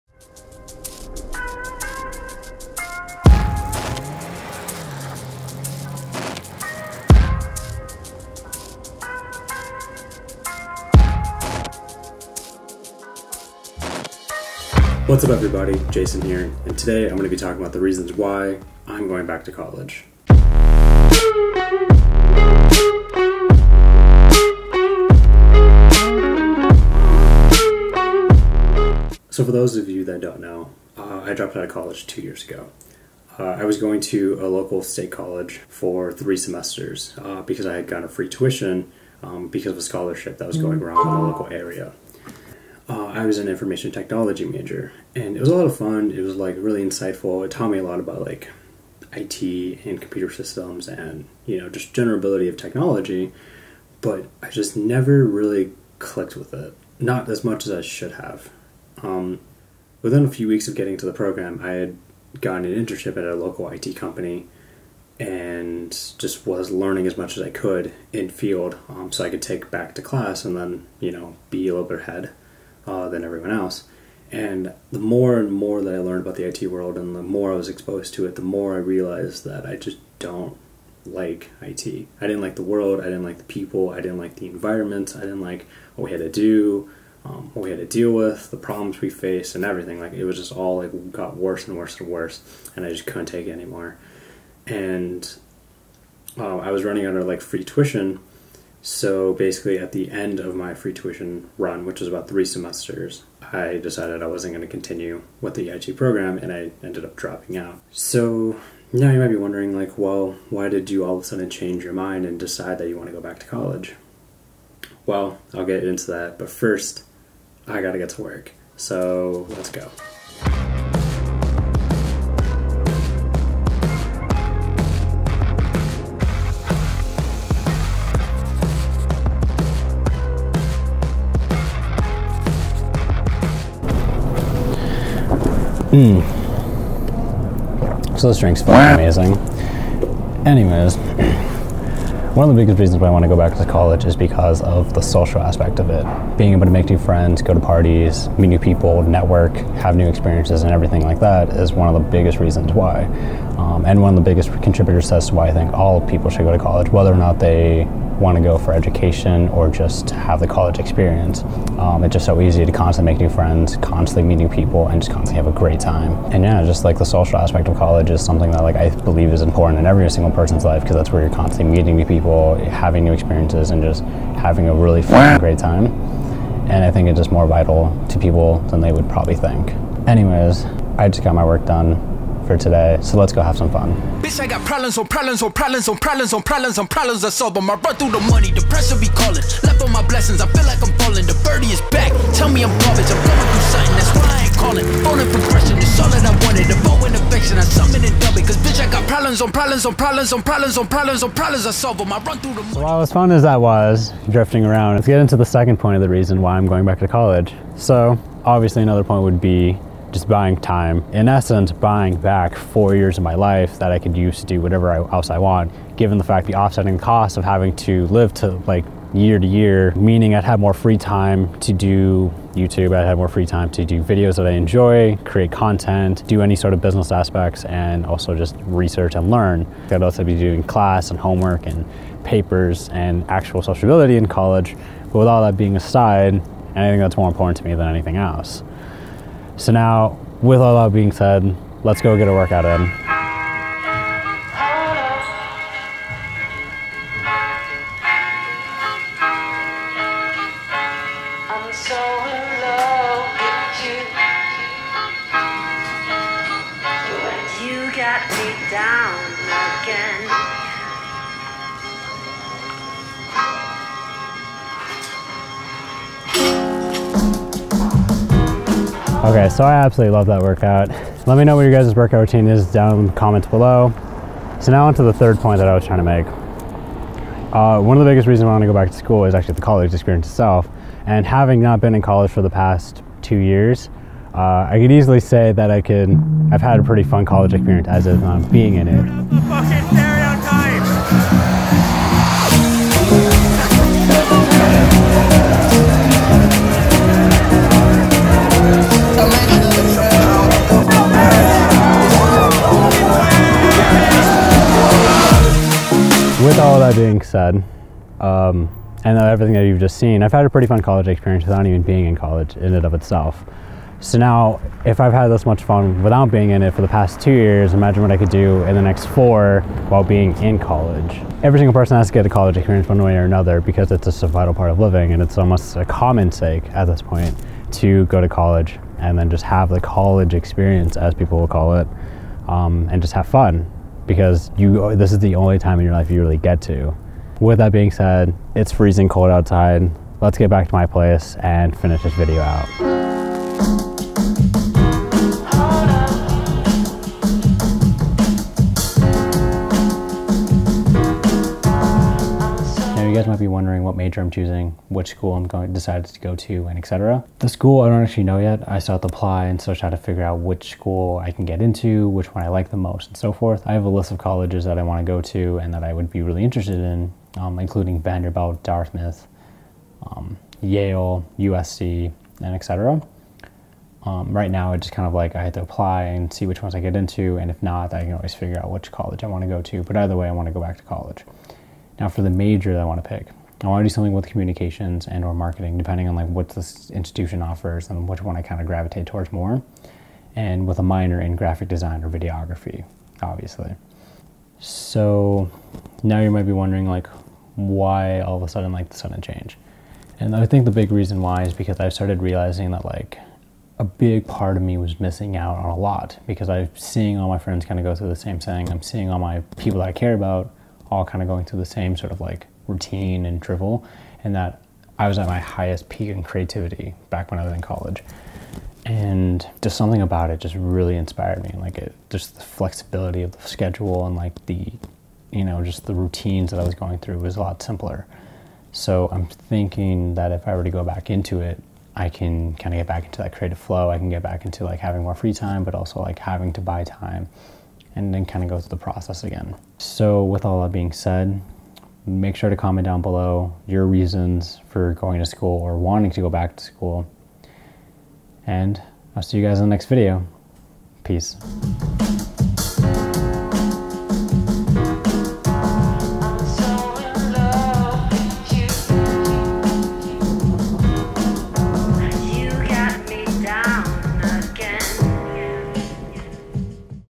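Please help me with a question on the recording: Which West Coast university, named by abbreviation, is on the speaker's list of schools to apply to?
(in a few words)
USC.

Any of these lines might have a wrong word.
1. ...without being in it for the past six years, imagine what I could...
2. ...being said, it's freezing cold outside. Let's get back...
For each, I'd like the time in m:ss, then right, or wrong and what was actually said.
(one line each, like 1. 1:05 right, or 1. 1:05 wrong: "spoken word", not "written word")
1. 5:16 wrong: "two", not "six"
2. 5:37 right.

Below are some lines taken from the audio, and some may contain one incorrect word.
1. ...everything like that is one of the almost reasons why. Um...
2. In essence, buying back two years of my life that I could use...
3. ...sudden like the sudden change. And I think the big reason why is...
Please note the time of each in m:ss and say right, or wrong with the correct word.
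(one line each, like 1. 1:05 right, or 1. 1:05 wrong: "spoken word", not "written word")
1. 2:30 wrong: "biggest", not "almost"
2. 3:31 wrong: "four", not "two"
3. 6:38 right.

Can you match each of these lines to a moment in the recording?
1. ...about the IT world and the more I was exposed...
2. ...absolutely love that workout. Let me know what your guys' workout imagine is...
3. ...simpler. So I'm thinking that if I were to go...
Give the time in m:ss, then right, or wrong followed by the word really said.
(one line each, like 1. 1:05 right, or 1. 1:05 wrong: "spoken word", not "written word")
1. 1:16 right
2. 4:29 wrong: "routine", not "imagine"
3. 7:07 right.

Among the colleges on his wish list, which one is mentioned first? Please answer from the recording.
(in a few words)
Vanderbilt.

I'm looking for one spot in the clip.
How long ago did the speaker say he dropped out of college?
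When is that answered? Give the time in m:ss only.
0:32.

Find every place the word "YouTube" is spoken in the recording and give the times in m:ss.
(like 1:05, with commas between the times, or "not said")
3:42.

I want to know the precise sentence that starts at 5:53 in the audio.
guys might be wondering what major I'm choosing, which school I'm going decided to go to, and etc.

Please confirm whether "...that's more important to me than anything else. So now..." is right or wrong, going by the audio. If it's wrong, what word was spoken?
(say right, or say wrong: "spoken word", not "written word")
right.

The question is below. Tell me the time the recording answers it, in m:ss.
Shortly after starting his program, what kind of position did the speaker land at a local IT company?
1:02.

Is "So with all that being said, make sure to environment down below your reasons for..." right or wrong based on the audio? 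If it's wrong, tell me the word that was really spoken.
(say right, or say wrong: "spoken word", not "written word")
wrong: "comment", not "environment".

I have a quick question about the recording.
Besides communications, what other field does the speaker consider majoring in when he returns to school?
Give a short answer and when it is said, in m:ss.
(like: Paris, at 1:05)
Marketing, at 6:25.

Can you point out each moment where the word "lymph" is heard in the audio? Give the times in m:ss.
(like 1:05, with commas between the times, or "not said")
not said.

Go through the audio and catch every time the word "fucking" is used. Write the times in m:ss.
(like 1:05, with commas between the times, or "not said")
2:18.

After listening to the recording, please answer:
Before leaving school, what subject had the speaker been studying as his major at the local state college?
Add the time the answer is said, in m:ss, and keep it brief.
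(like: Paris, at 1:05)
Information technology, at 0:43.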